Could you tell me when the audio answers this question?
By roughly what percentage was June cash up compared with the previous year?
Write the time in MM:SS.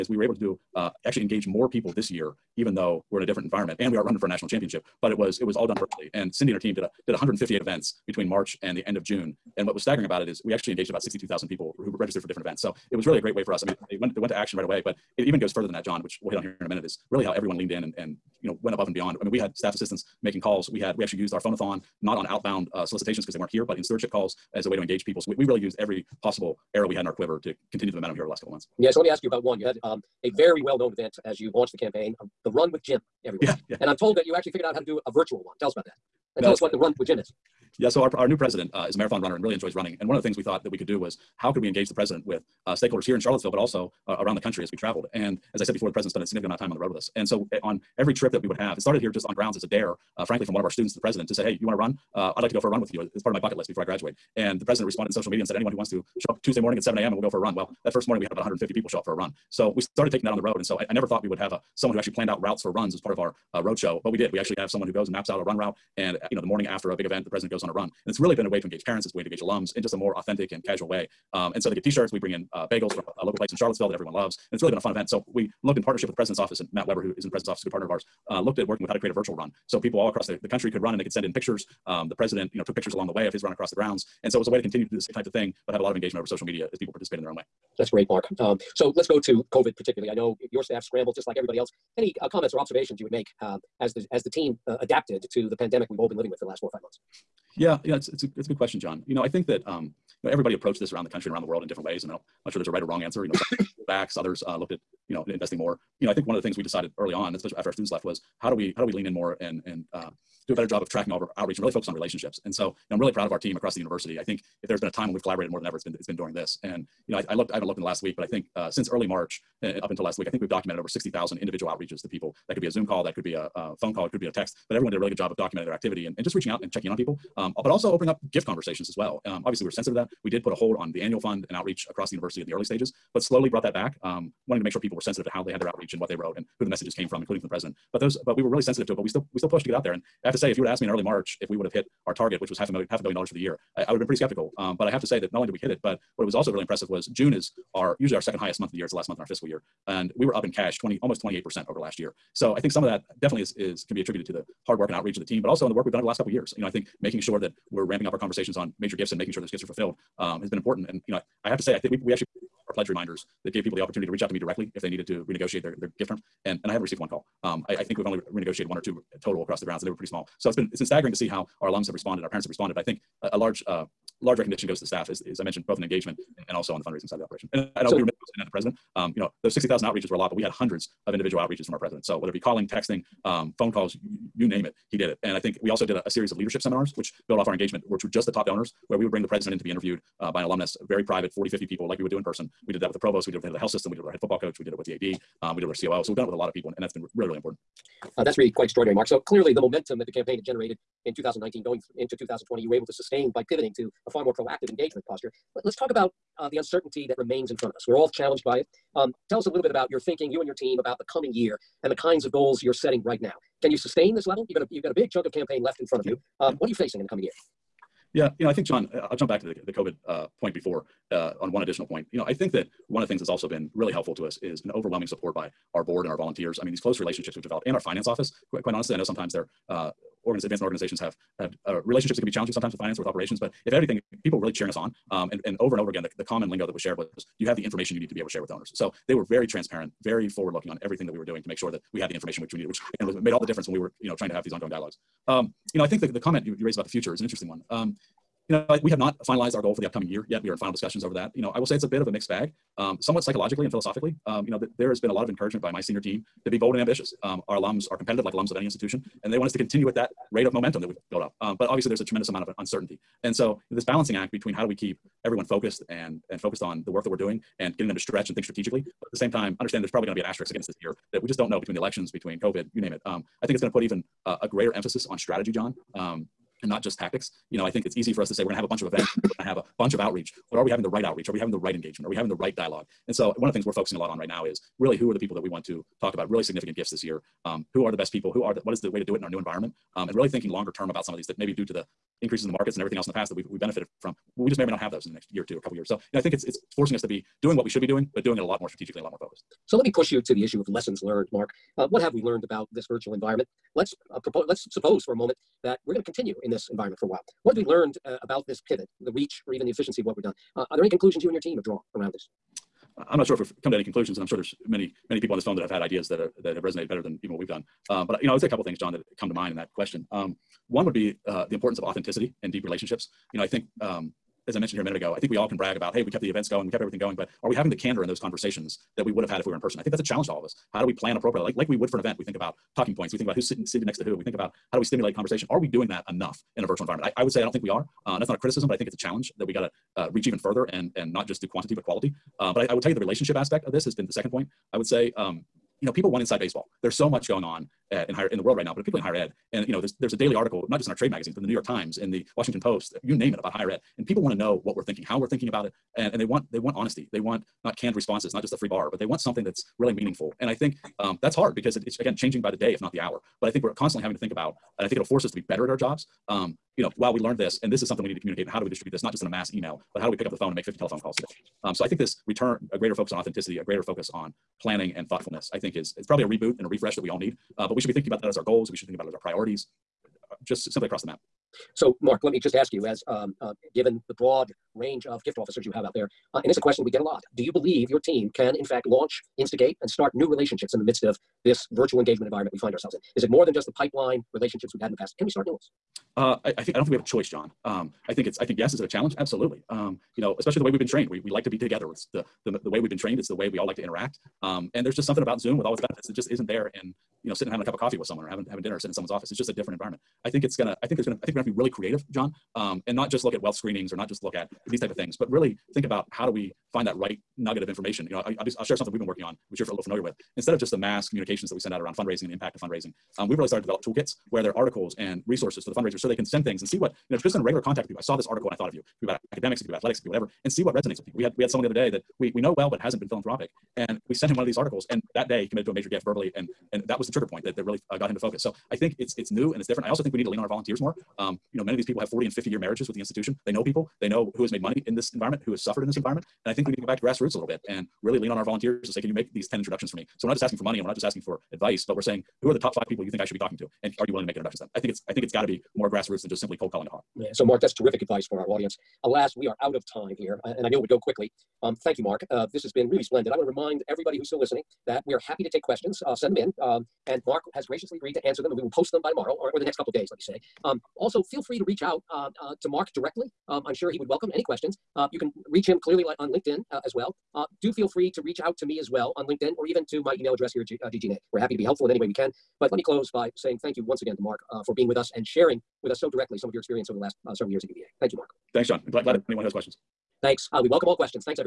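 02:31.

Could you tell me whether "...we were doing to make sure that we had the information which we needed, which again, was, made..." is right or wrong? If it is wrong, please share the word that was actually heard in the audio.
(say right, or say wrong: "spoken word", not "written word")
right.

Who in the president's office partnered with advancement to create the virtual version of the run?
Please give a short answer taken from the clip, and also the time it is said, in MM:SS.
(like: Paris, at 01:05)
Matt Weber, at 01:16.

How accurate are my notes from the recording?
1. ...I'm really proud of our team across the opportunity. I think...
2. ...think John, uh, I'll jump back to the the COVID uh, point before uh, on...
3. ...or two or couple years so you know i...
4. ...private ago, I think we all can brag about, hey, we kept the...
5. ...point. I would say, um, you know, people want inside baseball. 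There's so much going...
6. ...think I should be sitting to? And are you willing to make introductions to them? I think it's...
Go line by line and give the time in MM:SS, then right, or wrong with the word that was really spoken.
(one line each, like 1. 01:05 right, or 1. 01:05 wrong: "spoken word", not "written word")
1. 01:52 wrong: "university", not "opportunity"
2. 03:38 right
3. 04:55 right
4. 05:24 wrong: "minute", not "private"
5. 05:44 right
6. 07:33 wrong: "talking", not "sitting".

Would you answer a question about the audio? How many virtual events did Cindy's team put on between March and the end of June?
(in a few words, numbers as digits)
158.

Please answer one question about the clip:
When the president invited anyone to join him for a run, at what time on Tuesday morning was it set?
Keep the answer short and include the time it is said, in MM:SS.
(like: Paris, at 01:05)
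7 a.m., at 00:56.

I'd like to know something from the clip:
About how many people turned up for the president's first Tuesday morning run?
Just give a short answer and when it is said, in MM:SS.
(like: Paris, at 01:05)
150, at 00:58.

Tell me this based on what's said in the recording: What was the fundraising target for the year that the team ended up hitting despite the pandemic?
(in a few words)
Half a billion dollars.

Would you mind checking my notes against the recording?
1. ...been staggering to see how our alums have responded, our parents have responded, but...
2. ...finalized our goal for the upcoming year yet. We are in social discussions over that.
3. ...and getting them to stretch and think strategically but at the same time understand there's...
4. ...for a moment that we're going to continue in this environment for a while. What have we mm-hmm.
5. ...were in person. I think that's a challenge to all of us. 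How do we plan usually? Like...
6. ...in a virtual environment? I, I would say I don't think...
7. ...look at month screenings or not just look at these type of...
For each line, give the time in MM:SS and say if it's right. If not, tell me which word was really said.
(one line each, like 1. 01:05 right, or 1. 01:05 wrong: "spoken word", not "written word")
1. 02:50 right
2. 04:09 wrong: "final", not "social"
3. 04:27 right
4. 05:05 right
5. 05:29 wrong: "appropriately", not "usually"
6. 05:36 right
7. 06:53 wrong: "wealth", not "month".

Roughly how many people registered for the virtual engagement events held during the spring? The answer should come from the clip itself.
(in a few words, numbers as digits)
62,000.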